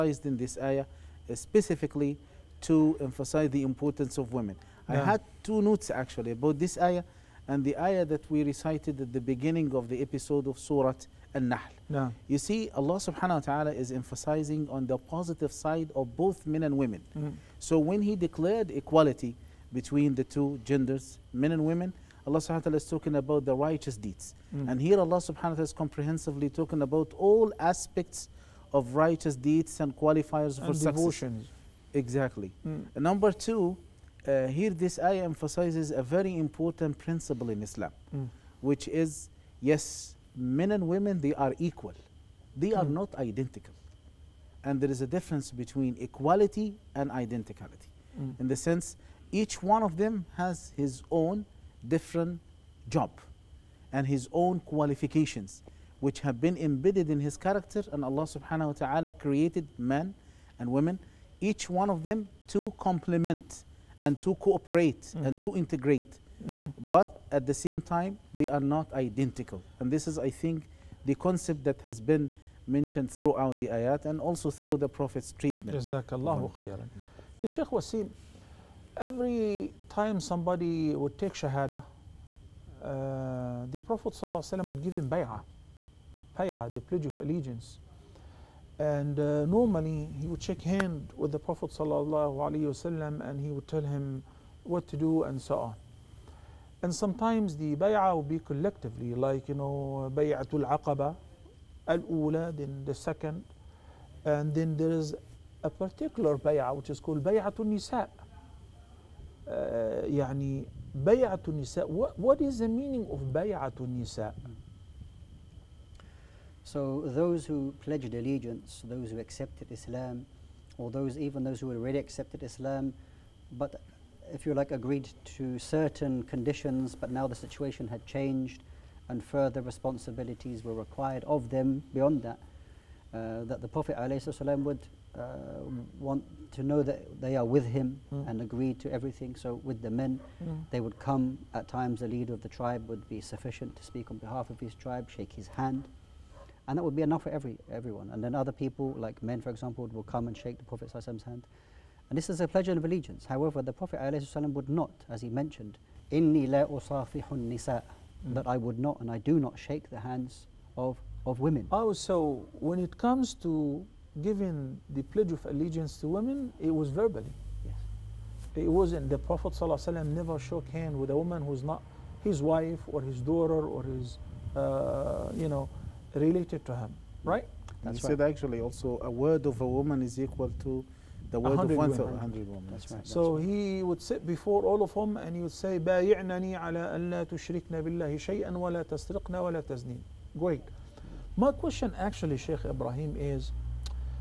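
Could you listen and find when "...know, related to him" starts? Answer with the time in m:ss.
2:55.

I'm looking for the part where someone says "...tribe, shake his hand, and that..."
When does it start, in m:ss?
2:24.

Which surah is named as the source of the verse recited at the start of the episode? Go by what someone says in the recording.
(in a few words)
Surah An-Nahl.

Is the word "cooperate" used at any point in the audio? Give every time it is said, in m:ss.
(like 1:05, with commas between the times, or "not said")
1:04.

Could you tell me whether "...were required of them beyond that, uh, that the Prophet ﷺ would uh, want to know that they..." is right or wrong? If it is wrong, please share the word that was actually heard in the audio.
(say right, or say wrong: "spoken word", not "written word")
right.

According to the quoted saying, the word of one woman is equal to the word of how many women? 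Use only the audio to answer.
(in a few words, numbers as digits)
100.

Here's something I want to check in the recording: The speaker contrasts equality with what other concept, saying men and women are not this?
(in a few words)
Identicality.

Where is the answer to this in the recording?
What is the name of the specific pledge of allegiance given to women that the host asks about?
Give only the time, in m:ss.
1:47.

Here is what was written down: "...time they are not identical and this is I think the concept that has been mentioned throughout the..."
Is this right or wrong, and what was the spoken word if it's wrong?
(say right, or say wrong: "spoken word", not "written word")
right.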